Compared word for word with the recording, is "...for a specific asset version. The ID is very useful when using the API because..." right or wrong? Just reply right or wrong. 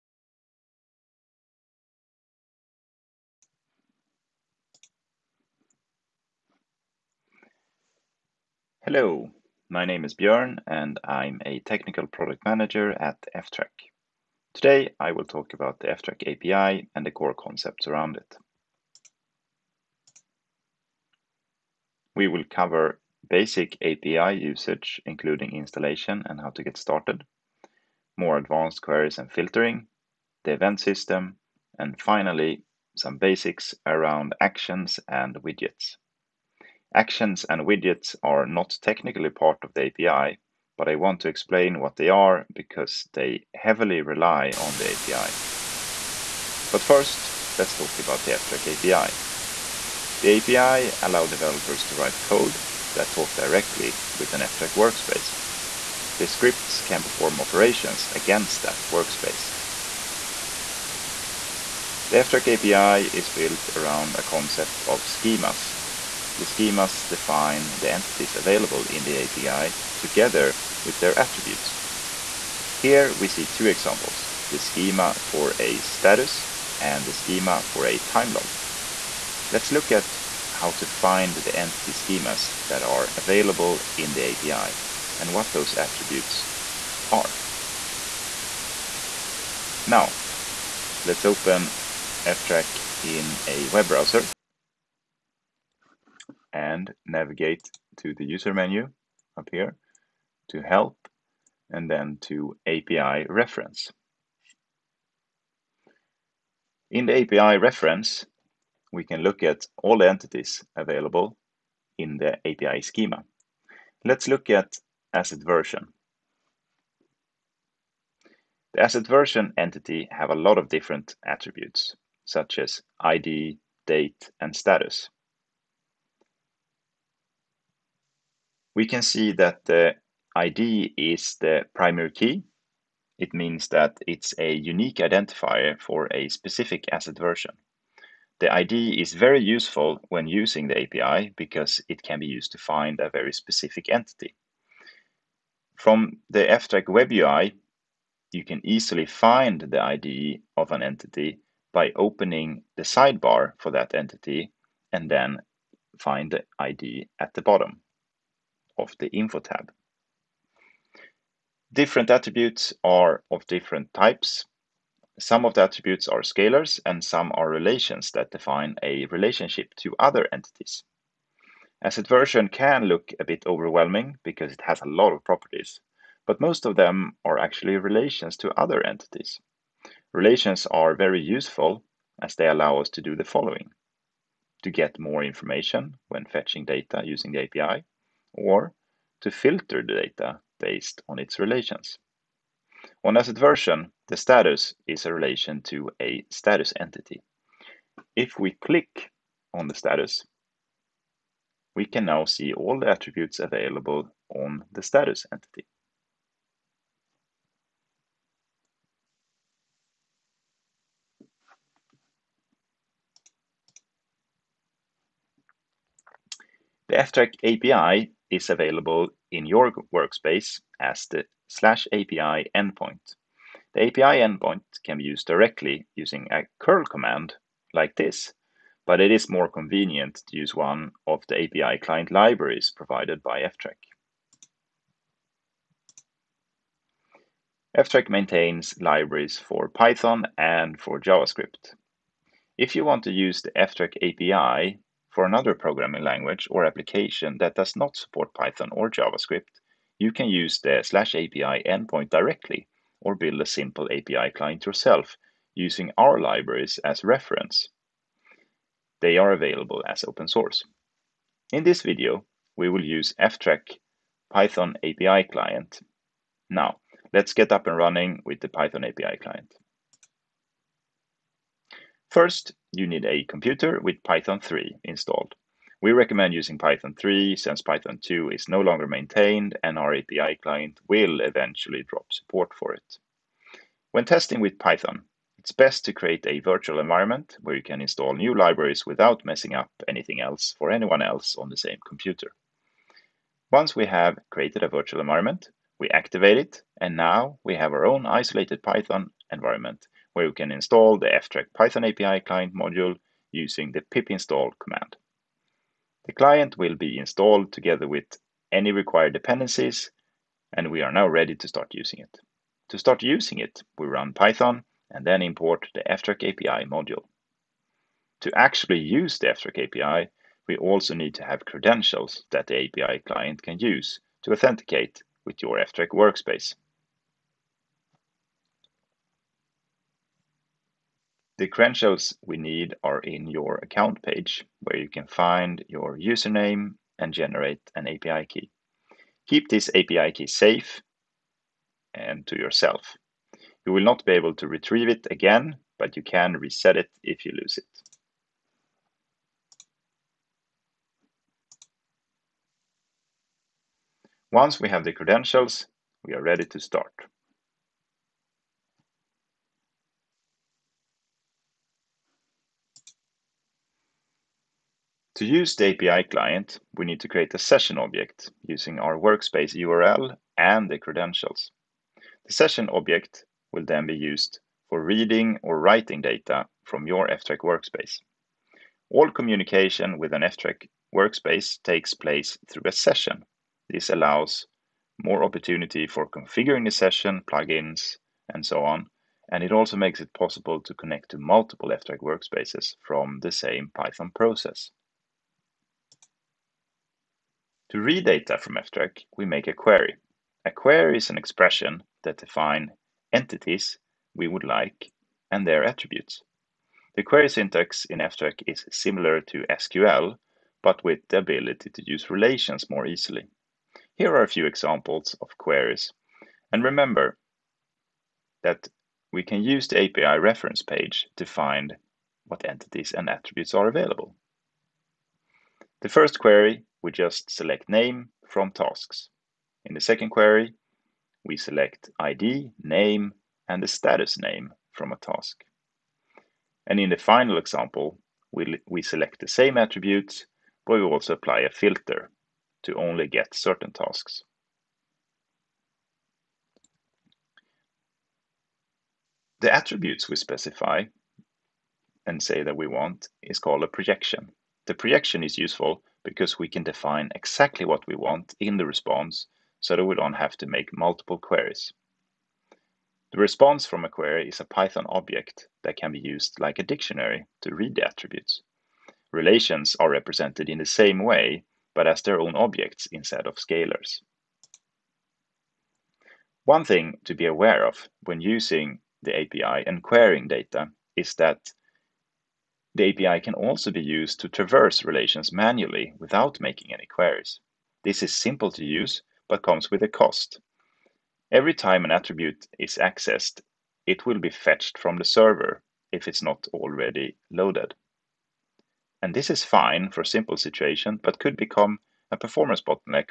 right.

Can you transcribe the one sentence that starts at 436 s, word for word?
And in the final example, we, we select the same attributes, but we also apply a filter to only get certain tasks.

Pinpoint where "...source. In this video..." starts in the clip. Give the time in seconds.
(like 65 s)
260 s.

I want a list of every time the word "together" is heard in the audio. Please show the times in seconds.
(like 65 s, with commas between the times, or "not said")
69 s, 307 s.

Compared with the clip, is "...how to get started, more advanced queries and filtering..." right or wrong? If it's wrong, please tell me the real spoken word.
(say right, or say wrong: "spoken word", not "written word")
right.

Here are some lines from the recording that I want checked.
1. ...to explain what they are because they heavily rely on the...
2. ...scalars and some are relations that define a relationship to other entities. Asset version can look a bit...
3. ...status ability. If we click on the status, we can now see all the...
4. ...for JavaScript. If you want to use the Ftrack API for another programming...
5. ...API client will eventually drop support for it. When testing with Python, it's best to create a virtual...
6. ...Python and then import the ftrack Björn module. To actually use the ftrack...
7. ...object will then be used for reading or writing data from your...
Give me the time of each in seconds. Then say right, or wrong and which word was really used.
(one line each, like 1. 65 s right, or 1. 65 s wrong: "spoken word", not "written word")
1. 41 s right
2. 166 s right
3. 196 s wrong: "entity", not "ability"
4. 240 s right
5. 279 s right
6. 314 s wrong: "API", not "Björn"
7. 372 s right.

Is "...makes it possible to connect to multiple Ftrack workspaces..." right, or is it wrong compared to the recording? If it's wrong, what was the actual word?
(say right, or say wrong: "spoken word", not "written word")
right.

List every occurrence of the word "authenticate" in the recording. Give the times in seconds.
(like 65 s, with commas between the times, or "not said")
324 s.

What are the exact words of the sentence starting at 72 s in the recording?
Here we see two examples, the schema for a status and the schema for a time log.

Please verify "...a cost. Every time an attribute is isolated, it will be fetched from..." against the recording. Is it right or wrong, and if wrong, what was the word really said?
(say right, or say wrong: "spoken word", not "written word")
wrong: "accessed", not "isolated".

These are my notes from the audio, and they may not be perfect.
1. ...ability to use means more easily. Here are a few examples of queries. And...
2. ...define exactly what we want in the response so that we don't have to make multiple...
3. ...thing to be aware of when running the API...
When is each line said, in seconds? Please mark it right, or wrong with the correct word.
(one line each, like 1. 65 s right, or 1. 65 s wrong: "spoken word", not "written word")
1. 411 s wrong: "relations", not "means"
2. 456 s right
3. 476 s wrong: "using", not "running".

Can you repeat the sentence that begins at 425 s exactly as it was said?
The first query, we just select name from tasks.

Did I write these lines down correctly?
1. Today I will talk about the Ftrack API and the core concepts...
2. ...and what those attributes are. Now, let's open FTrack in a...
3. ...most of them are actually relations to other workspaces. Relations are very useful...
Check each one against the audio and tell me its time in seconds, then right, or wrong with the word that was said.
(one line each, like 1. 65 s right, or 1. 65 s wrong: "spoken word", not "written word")
1. 14 s right
2. 85 s right
3. 176 s wrong: "entities", not "workspaces".